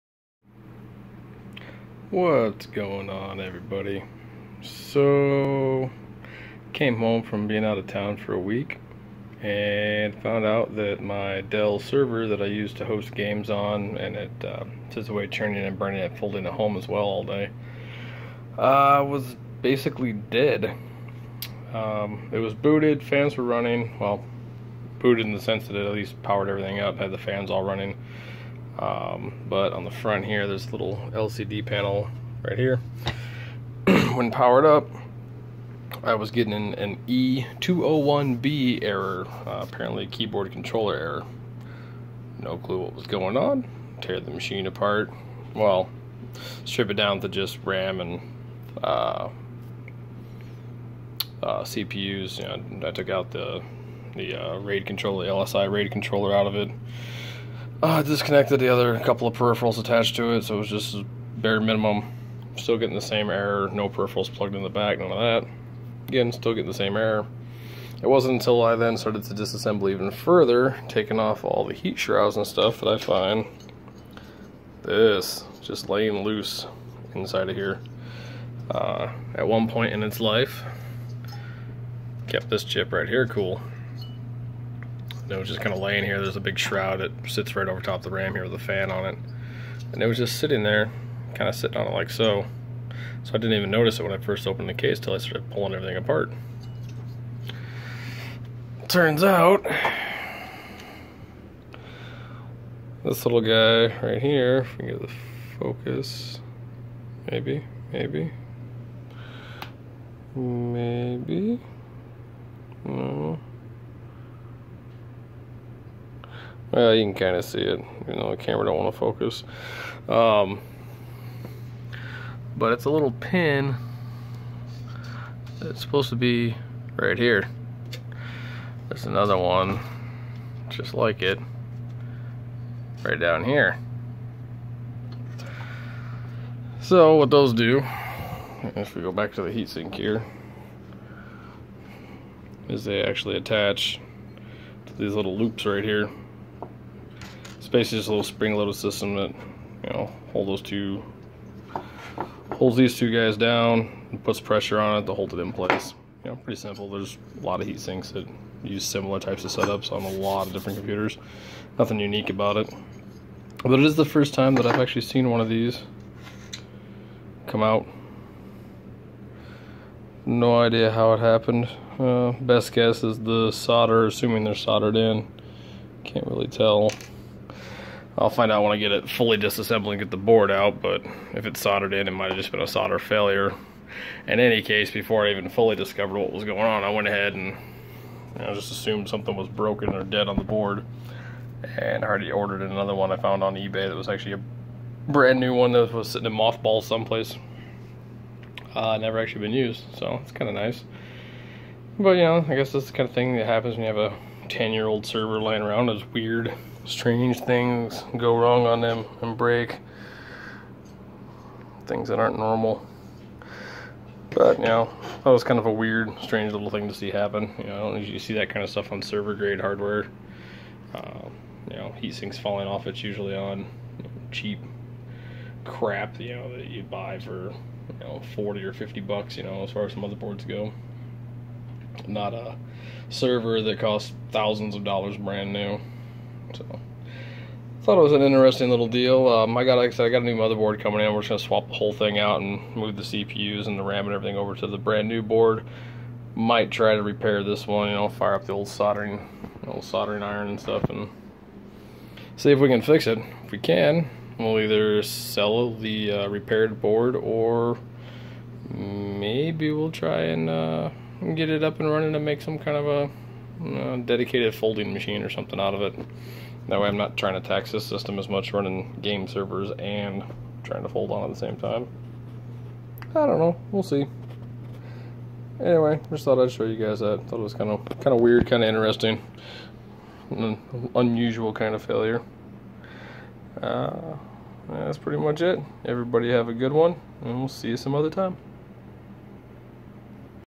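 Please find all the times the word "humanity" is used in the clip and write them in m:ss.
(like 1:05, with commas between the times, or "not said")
not said.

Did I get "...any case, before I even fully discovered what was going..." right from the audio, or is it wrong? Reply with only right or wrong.
right.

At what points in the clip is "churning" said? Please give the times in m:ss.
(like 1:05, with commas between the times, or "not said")
0:15.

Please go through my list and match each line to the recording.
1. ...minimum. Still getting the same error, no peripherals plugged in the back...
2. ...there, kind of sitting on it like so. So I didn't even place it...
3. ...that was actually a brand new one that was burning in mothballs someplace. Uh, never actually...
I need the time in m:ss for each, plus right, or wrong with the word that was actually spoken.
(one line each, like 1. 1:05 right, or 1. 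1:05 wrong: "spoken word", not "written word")
1. 1:01 right
2. 1:30 wrong: "notice", not "place"
3. 3:13 wrong: "sitting", not "burning".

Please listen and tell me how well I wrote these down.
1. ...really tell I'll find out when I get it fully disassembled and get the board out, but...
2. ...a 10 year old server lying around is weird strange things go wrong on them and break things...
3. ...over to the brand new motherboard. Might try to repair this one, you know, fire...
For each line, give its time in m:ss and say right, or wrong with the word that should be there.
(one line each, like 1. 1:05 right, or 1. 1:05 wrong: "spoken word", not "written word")
1. 2:56 right
2. 3:24 right
3. 4:04 wrong: "board", not "motherboard".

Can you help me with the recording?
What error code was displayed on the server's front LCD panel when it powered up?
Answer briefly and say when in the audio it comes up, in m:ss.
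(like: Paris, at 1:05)
E201B, at 0:37.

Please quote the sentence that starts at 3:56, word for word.
So thought it was an interesting little deal.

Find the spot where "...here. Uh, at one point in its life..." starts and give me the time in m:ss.
1:17.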